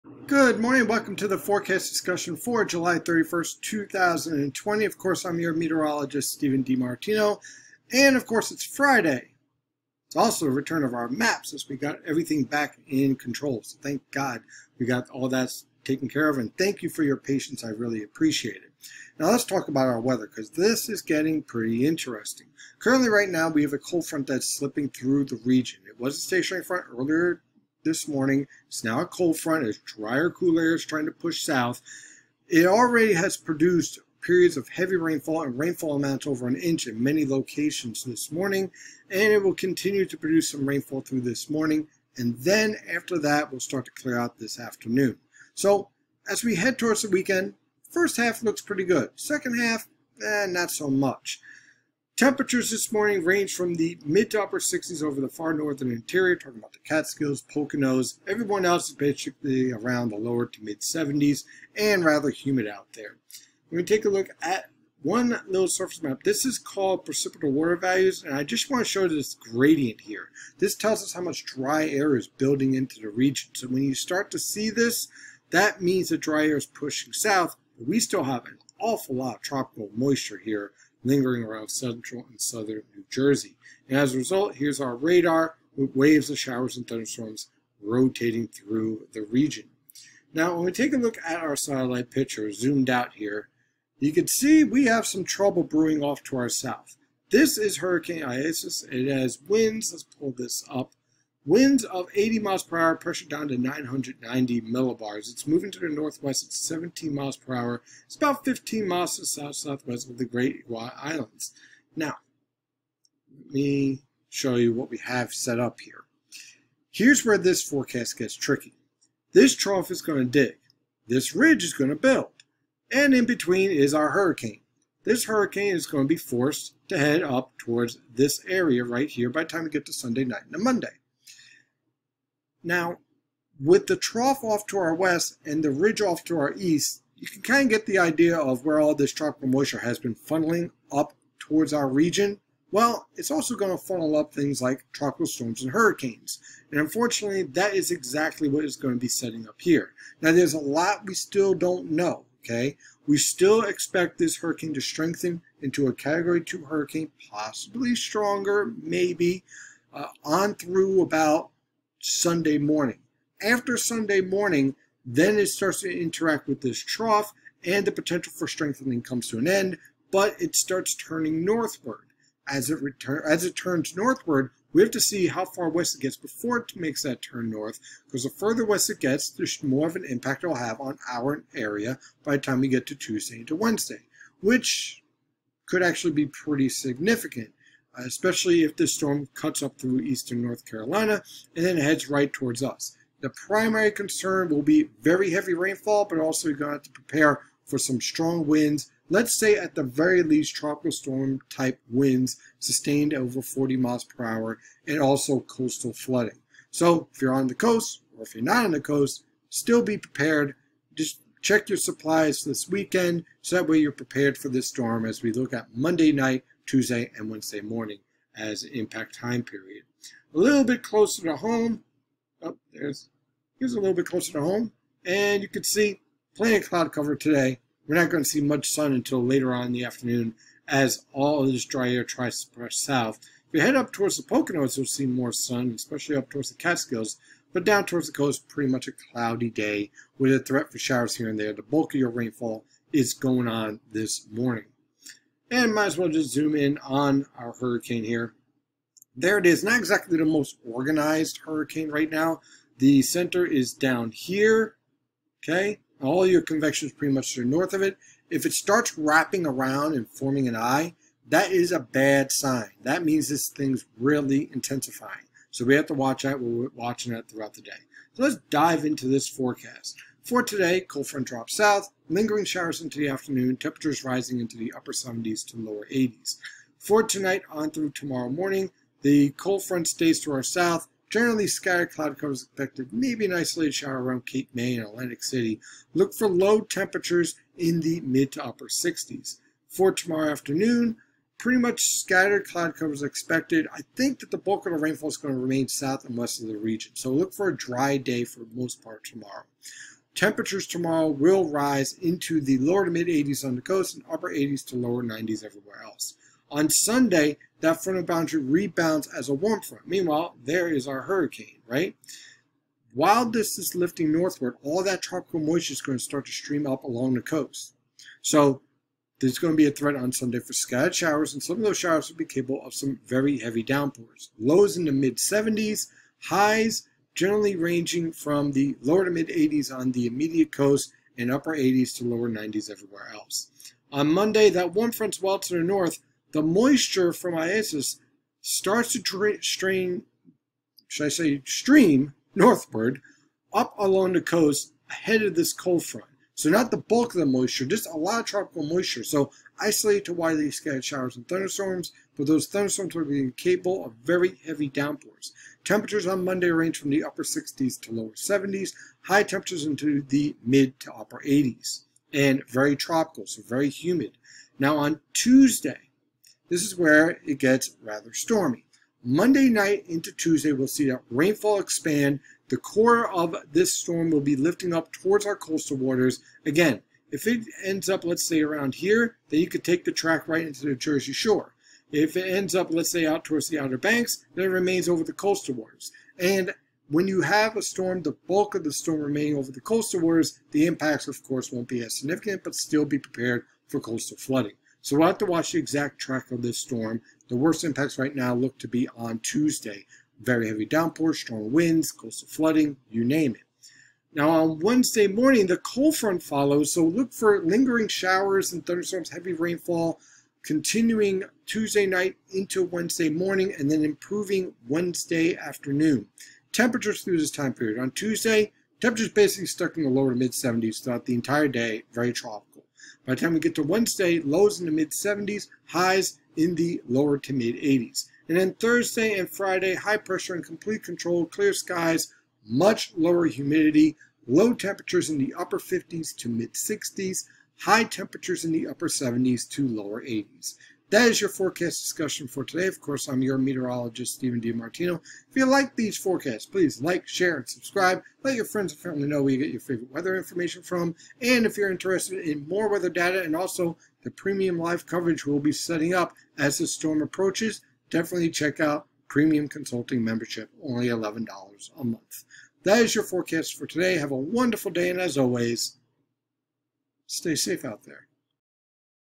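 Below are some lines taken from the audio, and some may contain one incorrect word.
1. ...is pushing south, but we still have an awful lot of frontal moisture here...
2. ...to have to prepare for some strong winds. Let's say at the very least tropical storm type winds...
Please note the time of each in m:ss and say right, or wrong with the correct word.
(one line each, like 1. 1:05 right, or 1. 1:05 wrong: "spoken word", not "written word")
1. 1:16 wrong: "tropical", not "frontal"
2. 3:16 right.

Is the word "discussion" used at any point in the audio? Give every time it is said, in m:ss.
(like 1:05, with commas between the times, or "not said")
0:01, 7:21.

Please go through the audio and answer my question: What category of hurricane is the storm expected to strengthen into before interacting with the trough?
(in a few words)
Category 2.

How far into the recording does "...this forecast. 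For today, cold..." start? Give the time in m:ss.
4:29.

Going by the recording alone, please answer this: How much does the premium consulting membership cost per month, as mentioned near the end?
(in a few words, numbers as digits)
$11.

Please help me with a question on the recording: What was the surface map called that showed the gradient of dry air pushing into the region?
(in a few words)
Precipitable water values.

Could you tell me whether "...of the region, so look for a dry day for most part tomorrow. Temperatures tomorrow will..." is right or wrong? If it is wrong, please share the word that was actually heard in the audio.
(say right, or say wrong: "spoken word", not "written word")
right.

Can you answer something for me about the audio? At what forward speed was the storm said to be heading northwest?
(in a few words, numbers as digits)
17 mph.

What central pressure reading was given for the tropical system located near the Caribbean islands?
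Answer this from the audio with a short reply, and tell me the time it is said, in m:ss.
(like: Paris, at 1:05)
990 millibars, at 1:43.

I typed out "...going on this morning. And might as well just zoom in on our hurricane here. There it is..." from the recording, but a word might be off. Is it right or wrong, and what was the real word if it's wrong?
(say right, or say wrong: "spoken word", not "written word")
right.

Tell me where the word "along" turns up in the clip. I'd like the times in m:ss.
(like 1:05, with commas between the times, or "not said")
5:16, 5:43.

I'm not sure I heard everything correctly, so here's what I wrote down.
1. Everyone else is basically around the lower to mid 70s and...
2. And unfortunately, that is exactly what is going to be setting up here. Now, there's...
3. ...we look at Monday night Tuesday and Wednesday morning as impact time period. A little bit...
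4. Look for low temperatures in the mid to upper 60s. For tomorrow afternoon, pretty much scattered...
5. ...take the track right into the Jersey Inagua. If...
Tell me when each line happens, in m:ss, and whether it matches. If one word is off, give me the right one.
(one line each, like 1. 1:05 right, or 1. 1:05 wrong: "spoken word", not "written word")
1. 0:58 right
2. 2:26 right
3. 3:35 right
4. 4:45 right
5. 6:19 wrong: "Shore", not "Inagua".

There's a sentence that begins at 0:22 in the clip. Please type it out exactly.
Currently right now we have a cold front that's slipping through the region.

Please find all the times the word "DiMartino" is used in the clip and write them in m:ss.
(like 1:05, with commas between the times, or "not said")
0:06, 7:24.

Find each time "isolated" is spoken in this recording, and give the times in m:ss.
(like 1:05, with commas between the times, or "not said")
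4:43, 5:49.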